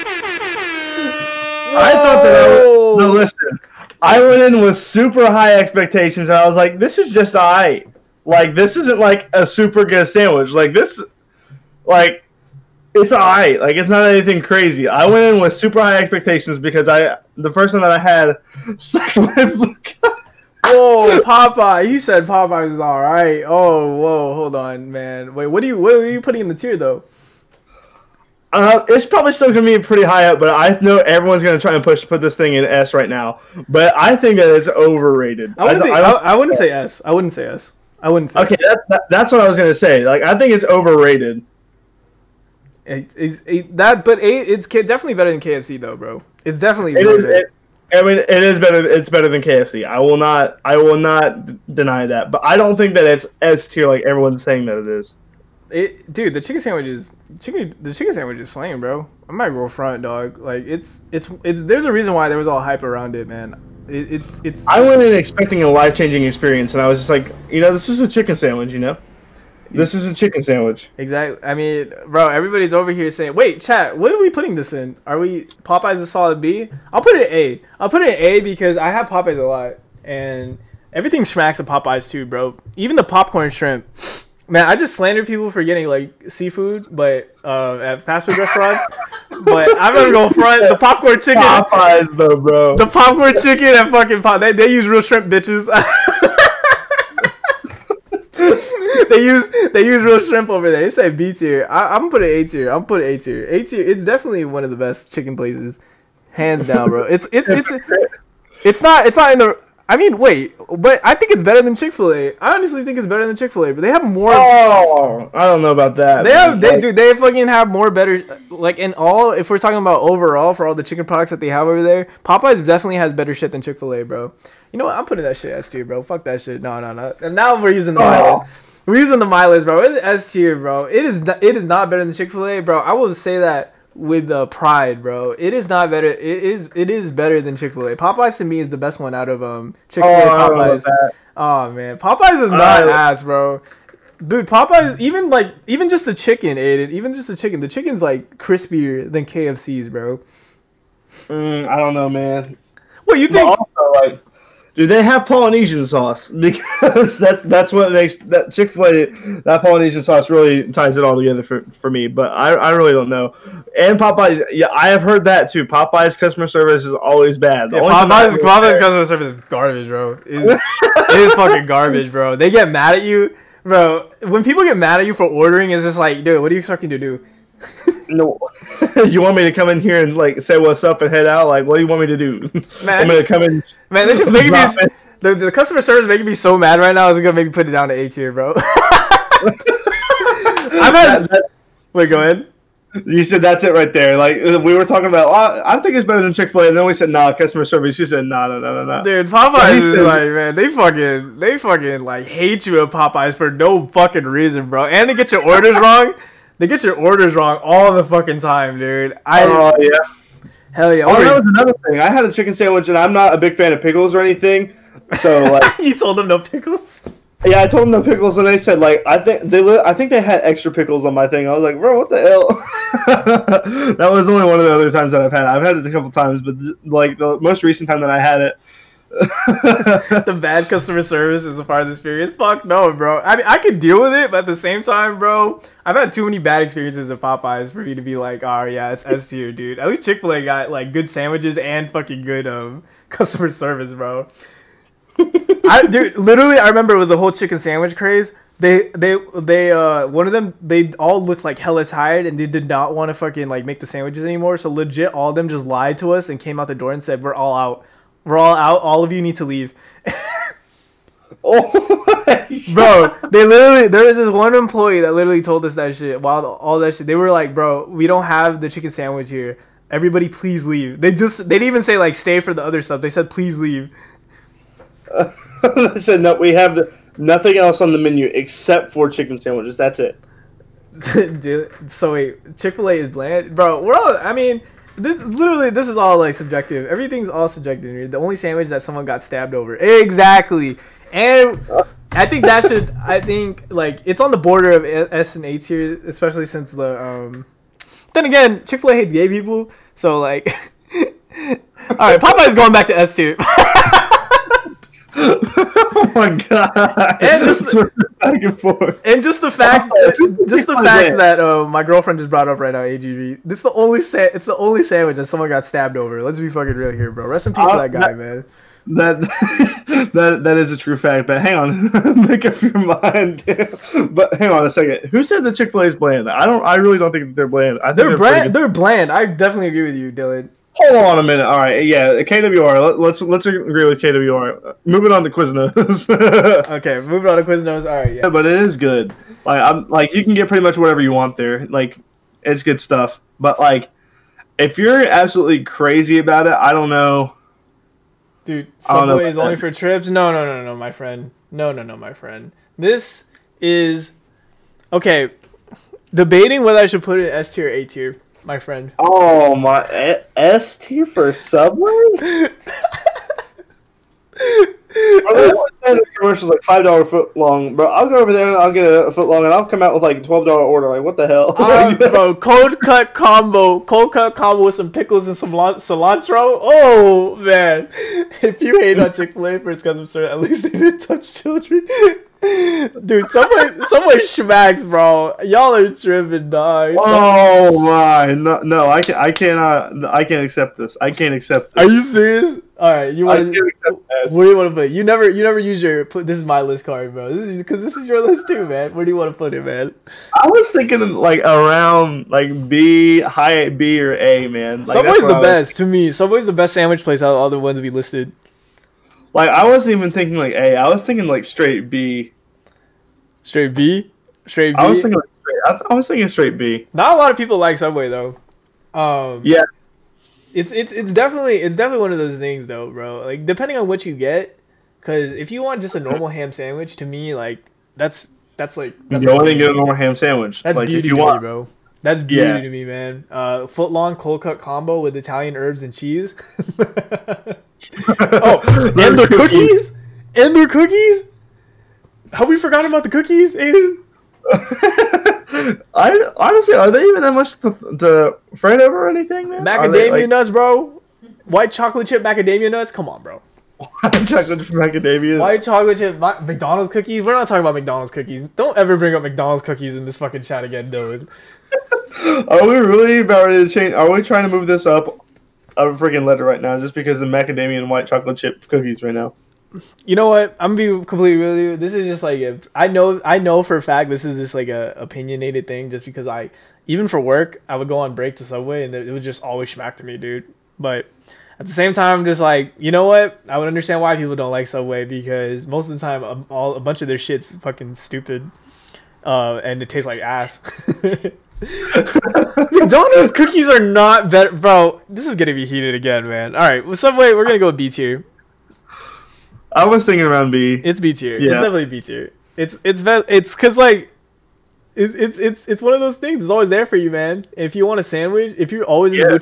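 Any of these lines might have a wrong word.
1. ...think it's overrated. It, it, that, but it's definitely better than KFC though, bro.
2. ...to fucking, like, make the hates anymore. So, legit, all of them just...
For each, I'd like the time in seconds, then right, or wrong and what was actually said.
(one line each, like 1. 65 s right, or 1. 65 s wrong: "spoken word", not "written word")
1. 40 s right
2. 253 s wrong: "sandwiches", not "hates".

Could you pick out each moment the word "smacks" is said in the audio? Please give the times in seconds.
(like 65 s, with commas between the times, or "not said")
81 s, 479 s.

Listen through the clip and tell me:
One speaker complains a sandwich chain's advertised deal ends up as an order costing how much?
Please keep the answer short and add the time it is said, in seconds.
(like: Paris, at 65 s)
$12, at 370 s.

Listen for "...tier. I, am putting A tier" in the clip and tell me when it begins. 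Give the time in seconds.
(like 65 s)
101 s.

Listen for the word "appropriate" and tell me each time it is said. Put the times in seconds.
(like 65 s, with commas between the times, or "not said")
not said.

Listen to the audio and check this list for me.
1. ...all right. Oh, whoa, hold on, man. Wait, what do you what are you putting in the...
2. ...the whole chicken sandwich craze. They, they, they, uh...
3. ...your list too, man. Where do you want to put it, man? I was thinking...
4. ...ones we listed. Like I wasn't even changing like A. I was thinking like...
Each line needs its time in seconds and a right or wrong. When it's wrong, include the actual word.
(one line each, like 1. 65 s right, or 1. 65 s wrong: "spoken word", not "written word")
1. 22 s right
2. 247 s right
3. 398 s right
4. 407 s wrong: "thinking", not "changing".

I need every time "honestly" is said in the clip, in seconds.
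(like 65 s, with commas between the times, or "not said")
112 s, 446 s.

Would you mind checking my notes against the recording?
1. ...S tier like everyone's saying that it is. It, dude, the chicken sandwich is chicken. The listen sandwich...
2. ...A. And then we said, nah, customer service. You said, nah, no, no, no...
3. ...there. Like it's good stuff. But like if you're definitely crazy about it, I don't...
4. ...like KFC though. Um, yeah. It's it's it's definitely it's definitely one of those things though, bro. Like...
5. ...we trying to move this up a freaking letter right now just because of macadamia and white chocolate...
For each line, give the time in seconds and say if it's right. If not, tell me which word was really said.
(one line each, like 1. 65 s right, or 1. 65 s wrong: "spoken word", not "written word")
1. 53 s wrong: "chicken", not "listen"
2. 196 s right
3. 341 s wrong: "absolutely", not "definitely"
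4. 417 s wrong: "Subway", not "KFC"
5. 464 s right.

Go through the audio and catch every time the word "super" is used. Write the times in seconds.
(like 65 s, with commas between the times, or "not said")
4 s, 9 s, 15 s.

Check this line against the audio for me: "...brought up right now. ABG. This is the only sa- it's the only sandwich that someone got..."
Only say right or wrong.
right.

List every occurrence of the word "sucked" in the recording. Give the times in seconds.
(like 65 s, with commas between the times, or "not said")
18 s.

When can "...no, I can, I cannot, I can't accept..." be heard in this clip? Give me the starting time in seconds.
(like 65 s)
388 s.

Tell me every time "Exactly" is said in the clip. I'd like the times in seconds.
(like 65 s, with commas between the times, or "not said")
70 s, 289 s.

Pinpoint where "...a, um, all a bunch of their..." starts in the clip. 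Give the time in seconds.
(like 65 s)
486 s.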